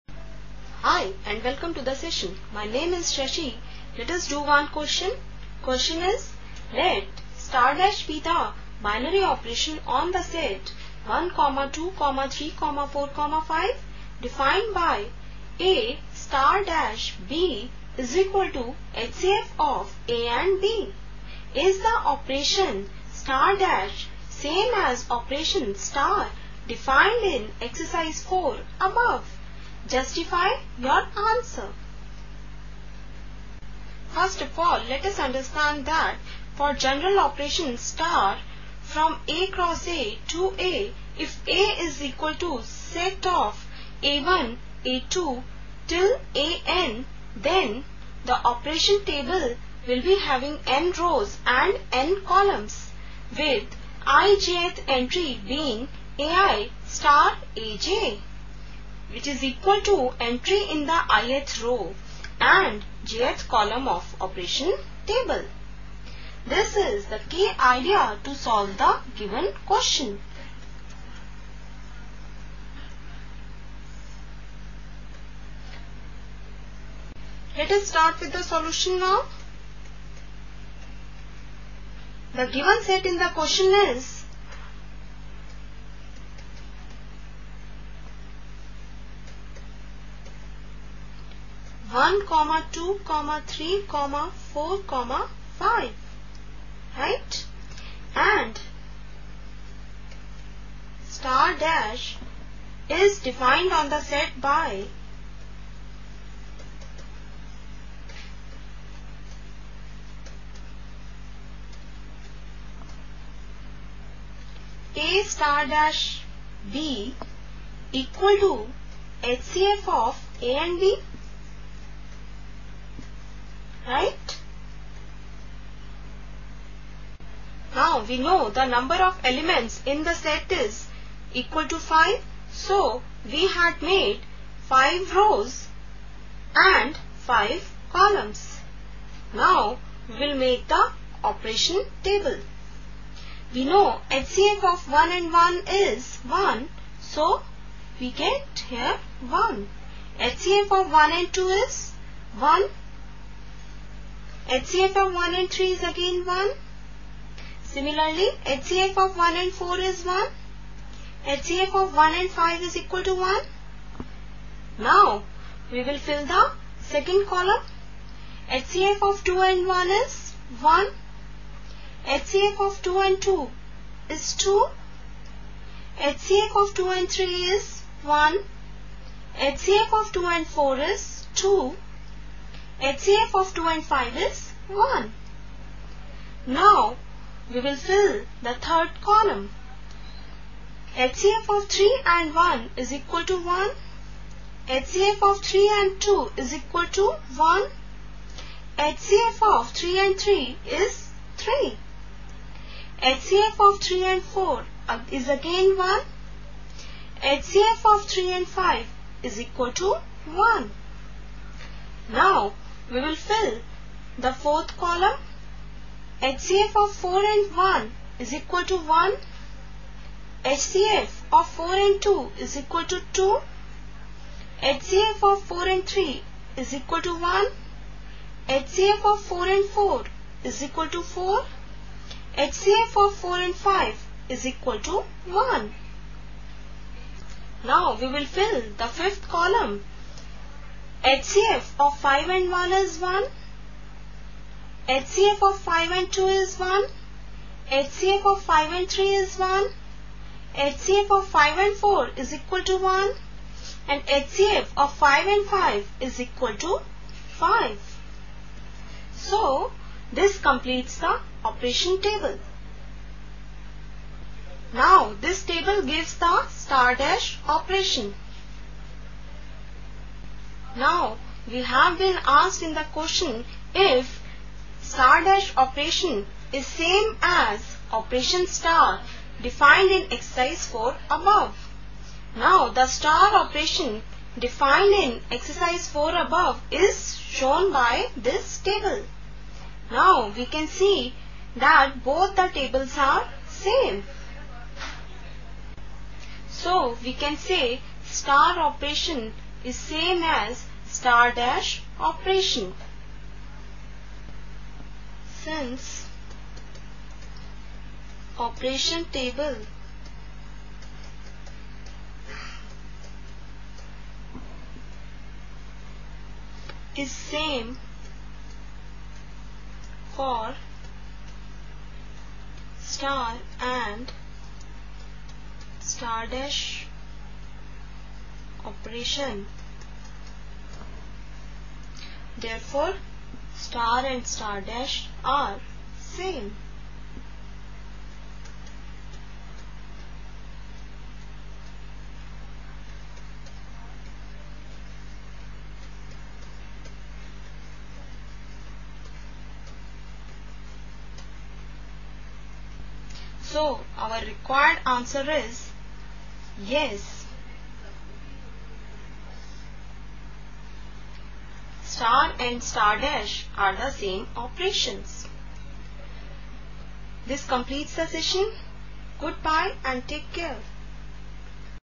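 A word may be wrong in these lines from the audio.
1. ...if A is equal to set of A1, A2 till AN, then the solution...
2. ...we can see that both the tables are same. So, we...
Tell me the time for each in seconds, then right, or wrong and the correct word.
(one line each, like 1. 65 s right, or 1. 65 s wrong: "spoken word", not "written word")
1. 41 s wrong: "operation", not "solution"
2. 290 s right.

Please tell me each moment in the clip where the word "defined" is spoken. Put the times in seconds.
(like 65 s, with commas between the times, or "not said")
14 s, 26 s, 103 s, 279 s, 284 s.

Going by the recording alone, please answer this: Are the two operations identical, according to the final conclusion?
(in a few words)
Yes.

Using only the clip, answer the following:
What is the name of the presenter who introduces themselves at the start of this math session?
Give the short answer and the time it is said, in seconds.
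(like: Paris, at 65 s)
Shashi, at 3 s.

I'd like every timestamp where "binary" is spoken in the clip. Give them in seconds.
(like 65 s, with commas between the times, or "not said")
8 s.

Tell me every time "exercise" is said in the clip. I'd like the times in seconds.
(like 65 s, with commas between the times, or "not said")
27 s, 280 s, 285 s.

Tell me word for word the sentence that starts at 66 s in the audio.
This is the key idea to solve the given question.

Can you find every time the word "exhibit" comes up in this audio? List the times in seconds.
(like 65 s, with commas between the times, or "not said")
not said.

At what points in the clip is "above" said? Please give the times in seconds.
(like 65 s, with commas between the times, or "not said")
28 s, 281 s, 286 s.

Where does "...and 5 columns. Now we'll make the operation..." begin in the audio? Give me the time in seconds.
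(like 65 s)
136 s.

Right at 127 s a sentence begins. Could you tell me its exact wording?
Now we know the number of elements in the set is equal to 5.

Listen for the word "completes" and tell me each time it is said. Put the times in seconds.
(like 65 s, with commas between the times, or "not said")
260 s, 367 s.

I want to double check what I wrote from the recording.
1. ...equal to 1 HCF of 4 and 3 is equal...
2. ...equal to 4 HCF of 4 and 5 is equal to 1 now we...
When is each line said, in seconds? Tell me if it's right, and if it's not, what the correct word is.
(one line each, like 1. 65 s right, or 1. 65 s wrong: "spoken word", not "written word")
1. 222 s wrong: "2", not "1"
2. 230 s right.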